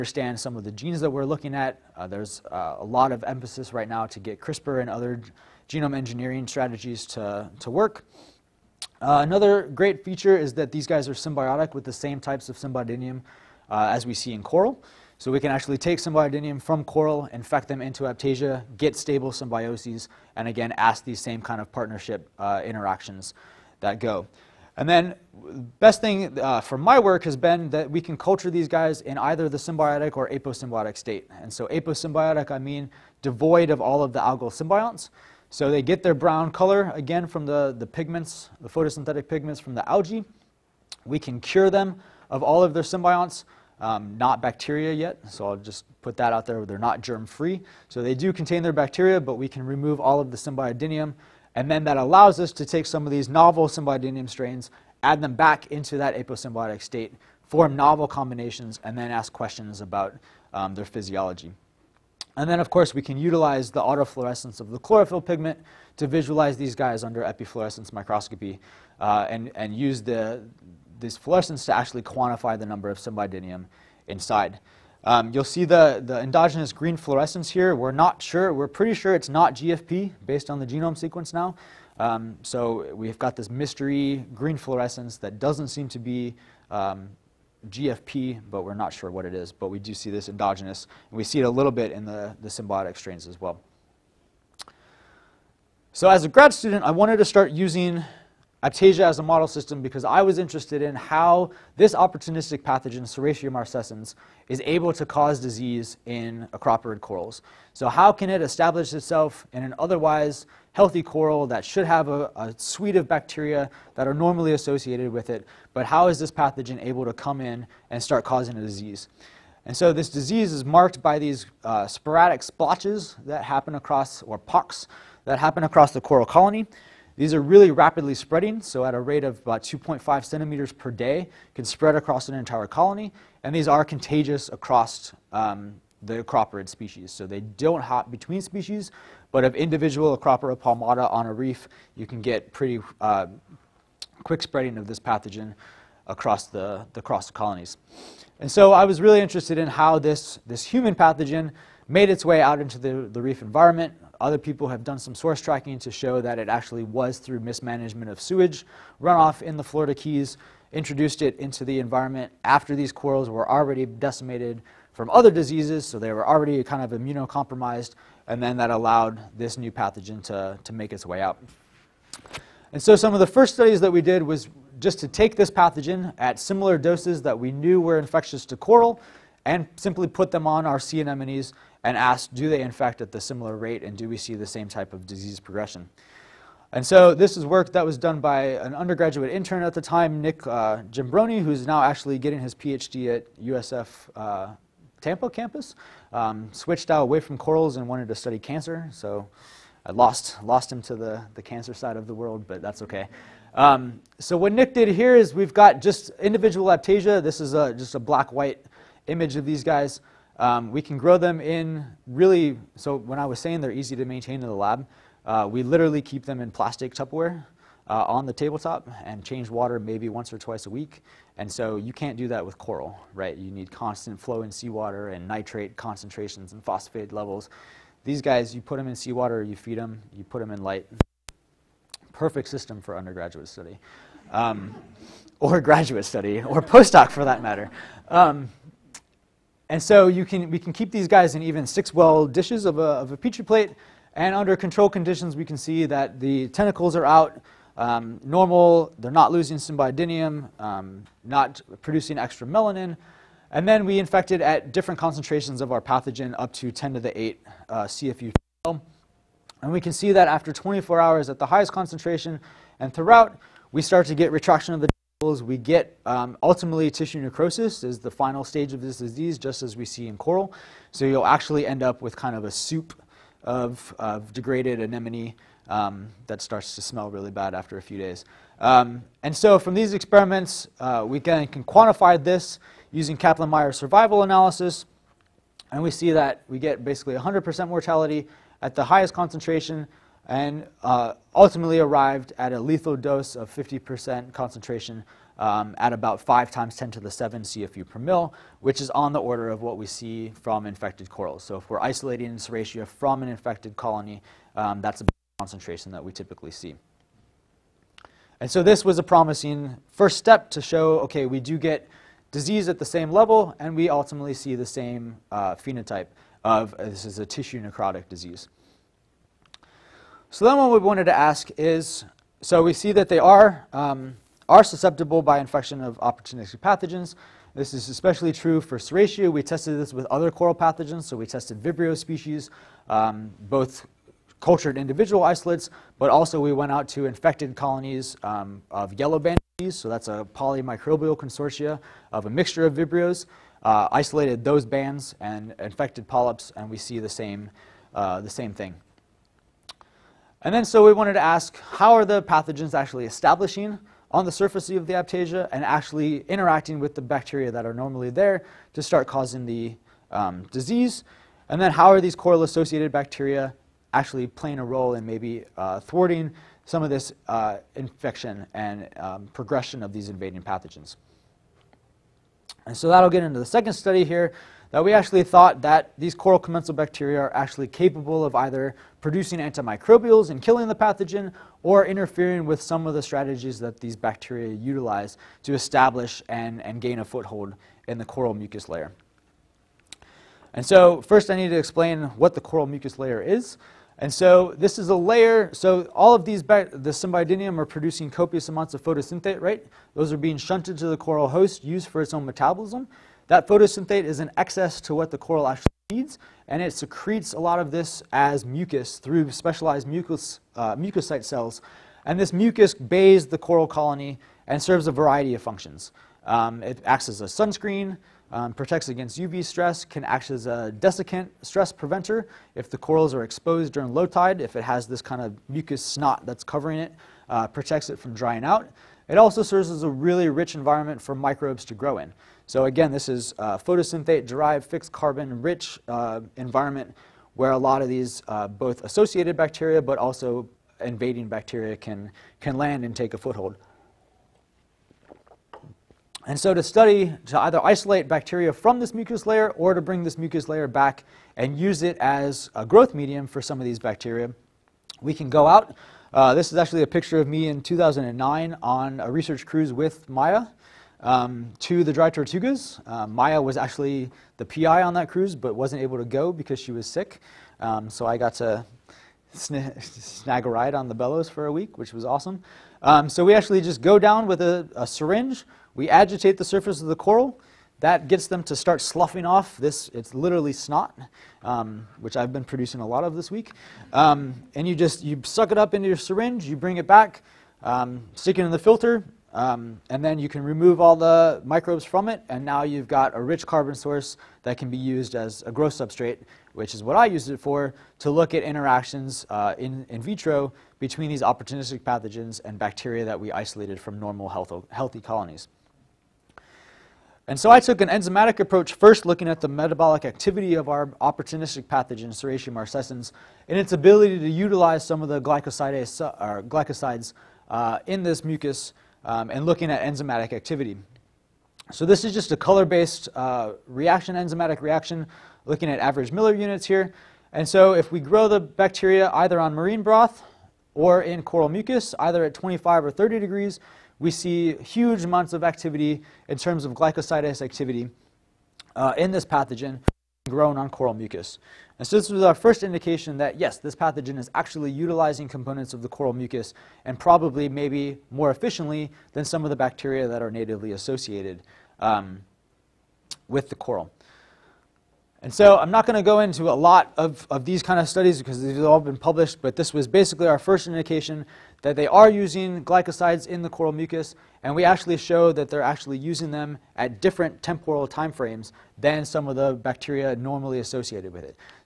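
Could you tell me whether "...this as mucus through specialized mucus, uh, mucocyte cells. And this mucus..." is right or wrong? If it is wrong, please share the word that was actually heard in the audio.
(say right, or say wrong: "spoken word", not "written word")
right.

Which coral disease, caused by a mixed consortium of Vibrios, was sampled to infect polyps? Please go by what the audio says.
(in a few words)
Yellow band disease.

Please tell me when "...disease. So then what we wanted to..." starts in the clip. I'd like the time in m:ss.
5:18.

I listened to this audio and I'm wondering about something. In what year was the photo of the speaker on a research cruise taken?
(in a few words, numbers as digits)
2009.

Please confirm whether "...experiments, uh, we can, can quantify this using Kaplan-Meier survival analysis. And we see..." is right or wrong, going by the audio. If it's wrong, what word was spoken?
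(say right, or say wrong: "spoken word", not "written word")
right.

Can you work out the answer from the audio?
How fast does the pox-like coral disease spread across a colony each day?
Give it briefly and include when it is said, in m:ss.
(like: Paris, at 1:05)
2.5 centimeters, at 2:09.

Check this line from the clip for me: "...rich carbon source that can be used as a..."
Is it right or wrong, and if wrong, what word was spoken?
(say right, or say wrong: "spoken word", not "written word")
right.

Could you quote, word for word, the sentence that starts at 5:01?
So if we're isolating Serratia from an infected colony, um, that's the concentration that we typically see.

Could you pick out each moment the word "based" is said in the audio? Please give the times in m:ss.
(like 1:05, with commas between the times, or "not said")
1:20, 8:42.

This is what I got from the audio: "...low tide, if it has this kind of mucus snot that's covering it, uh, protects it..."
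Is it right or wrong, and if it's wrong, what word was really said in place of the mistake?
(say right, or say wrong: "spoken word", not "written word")
right.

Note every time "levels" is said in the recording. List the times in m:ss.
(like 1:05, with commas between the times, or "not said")
3:47, 5:13.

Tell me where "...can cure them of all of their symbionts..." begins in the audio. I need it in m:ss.
0:41.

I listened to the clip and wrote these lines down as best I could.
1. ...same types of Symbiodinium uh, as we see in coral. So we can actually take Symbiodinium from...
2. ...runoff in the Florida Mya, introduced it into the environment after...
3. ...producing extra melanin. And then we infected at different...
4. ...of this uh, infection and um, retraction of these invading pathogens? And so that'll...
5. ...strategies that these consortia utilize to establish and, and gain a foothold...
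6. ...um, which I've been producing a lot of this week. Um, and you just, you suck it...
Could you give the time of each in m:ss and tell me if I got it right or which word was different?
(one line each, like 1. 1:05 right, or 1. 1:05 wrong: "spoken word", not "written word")
1. 0:11 right
2. 2:39 wrong: "Keys", not "Mya"
3. 4:11 right
4. 6:06 wrong: "progression", not "retraction"
5. 6:22 wrong: "bacteria", not "consortia"
6. 8:01 right.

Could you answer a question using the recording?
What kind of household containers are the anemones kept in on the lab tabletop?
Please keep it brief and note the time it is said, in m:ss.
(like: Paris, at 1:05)
Plastic Tupperware, at 3:36.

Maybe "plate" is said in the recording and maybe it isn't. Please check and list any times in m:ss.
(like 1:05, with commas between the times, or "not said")
4:03.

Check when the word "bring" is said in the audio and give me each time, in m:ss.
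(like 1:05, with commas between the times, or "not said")
7:29, 8:06.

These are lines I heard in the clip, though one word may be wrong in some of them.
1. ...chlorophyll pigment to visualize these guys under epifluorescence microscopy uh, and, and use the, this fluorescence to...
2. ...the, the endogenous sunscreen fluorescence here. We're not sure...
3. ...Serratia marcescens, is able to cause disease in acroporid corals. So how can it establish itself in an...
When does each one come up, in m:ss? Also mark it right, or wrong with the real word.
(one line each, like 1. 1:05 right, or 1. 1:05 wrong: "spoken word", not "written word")
1. 1:04 right
2. 1:15 wrong: "green", not "sunscreen"
3. 1:43 right.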